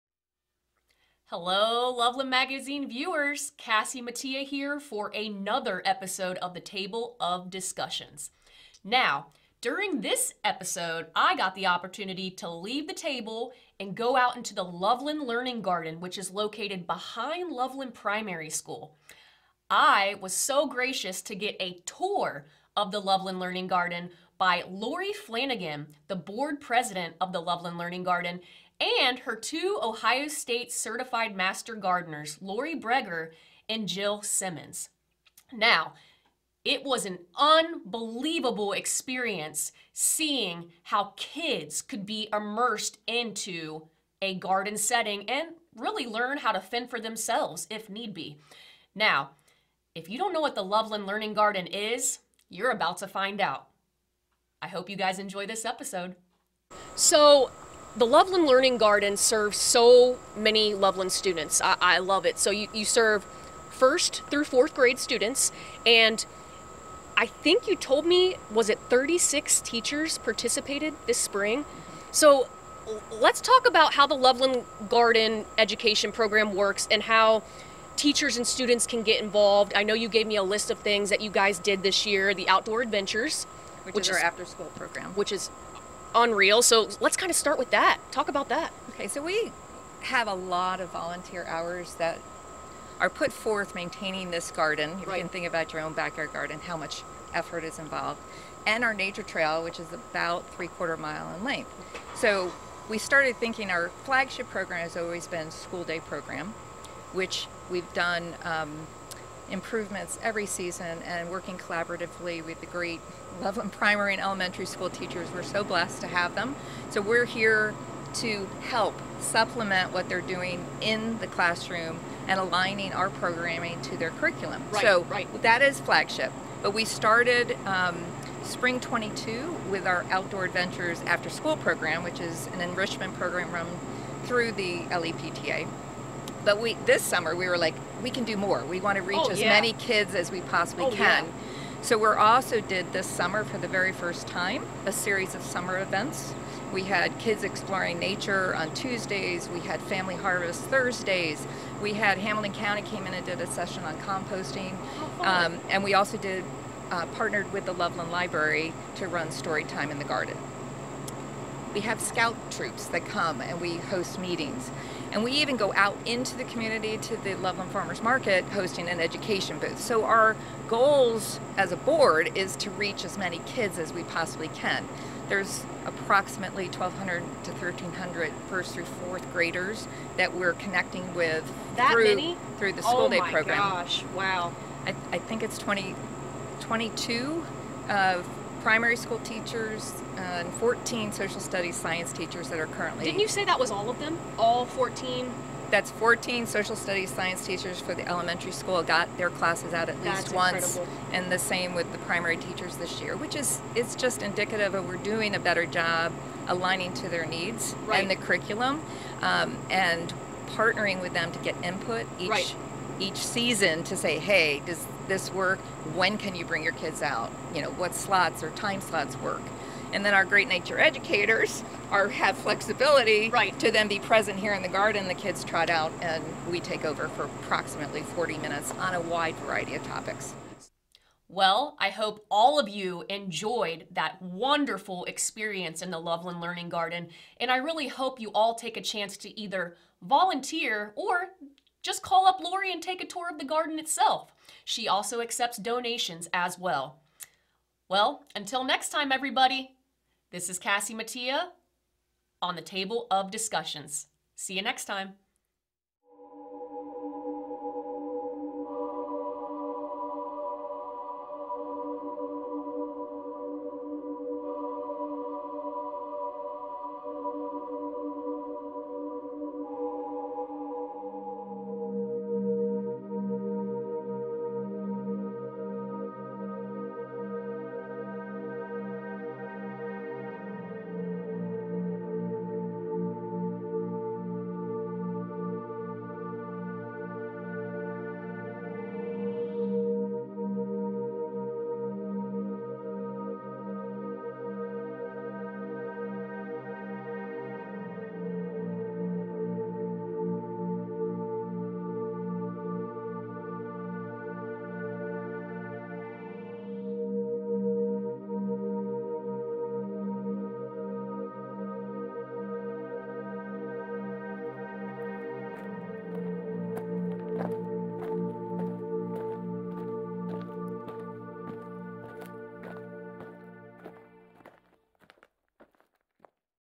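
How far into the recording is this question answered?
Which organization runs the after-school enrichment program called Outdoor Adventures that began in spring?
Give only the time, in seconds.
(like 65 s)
134 s.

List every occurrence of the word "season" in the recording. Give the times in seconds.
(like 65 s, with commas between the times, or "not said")
110 s, 213 s.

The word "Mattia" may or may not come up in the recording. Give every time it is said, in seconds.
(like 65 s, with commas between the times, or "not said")
4 s, 250 s.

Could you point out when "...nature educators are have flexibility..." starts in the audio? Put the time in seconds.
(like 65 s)
220 s.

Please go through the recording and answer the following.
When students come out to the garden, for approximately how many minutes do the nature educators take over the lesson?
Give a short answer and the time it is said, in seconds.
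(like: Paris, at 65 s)
40 minutes, at 228 s.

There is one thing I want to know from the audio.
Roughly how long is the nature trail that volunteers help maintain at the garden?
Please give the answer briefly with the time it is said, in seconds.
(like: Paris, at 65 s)
three quarter mile, at 100 s.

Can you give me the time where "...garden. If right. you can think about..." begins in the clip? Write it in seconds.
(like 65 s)
94 s.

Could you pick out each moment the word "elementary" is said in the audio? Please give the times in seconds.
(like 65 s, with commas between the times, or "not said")
114 s, 198 s.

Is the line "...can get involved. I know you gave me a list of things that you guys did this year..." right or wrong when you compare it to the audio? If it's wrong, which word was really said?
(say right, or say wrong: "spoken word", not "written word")
right.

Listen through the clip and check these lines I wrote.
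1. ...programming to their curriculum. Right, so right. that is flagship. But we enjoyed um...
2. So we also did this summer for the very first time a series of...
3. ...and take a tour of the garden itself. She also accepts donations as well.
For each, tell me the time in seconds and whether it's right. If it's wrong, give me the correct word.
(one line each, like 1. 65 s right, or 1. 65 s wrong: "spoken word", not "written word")
1. 123 s wrong: "started", not "enjoyed"
2. 141 s right
3. 242 s right.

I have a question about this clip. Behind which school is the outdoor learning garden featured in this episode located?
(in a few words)
Loveland Primary School.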